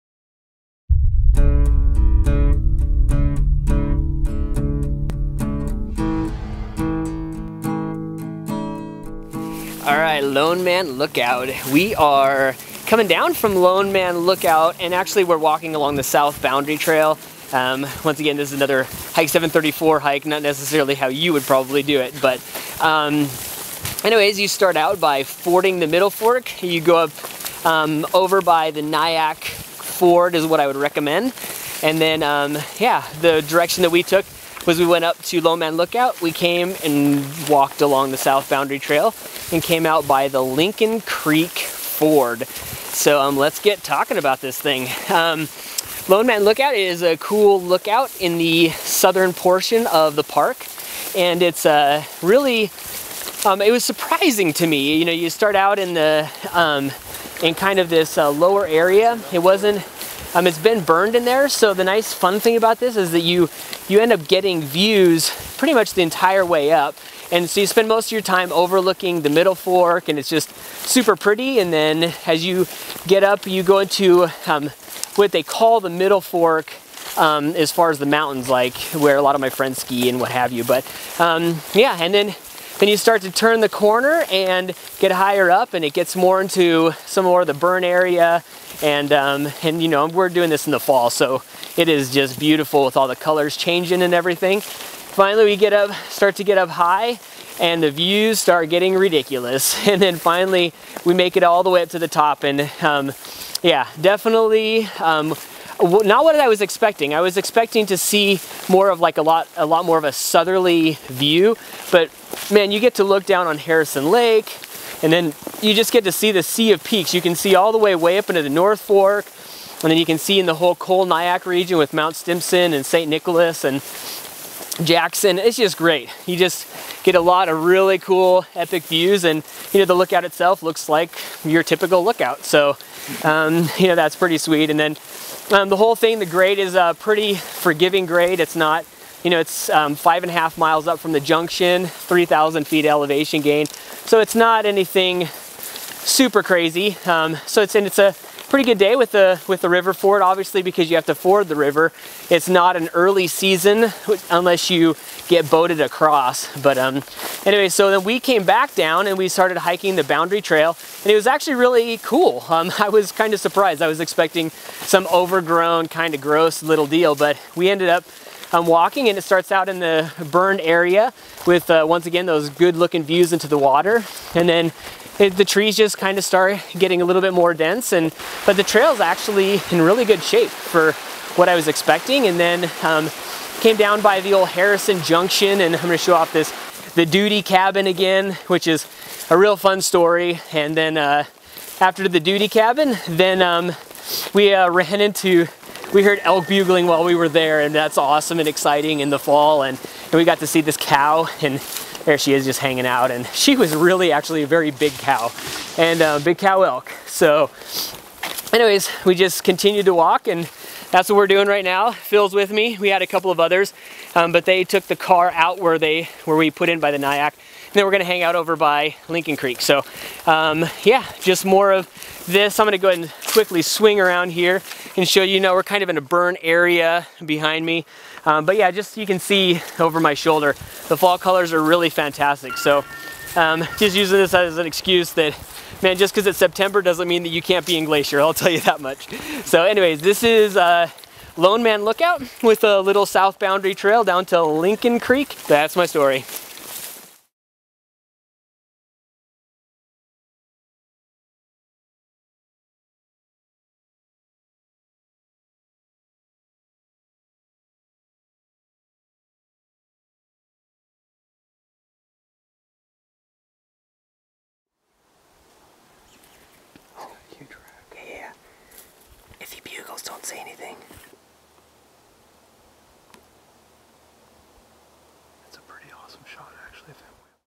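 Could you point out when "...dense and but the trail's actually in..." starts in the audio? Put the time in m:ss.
2:57.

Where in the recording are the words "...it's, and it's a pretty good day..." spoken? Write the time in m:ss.
2:27.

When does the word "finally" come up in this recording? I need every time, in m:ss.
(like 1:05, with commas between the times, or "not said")
1:34, 1:40.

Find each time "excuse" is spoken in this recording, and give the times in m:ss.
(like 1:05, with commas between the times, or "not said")
3:54.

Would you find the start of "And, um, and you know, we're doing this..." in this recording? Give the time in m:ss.
1:28.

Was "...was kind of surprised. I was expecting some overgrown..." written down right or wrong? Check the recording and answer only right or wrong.
right.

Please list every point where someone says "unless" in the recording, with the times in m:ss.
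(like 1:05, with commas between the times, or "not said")
2:34.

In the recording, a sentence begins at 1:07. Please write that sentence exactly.
And so you spend most of your time overlooking the middle fork and it's just super pretty.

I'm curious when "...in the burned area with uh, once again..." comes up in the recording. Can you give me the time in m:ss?
2:49.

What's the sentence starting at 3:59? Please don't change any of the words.
So anyways, this is uh, Lone Man Lookout with a little south boundary trail down to Lincoln Creek.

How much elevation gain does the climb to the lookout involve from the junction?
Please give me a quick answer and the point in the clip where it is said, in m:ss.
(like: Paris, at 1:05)
3,000 feet, at 2:21.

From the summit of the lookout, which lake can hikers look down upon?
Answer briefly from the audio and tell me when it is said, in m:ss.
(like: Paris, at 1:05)
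Harrison Lake, at 1:53.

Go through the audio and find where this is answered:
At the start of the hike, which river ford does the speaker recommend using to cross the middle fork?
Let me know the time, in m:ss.
0:28.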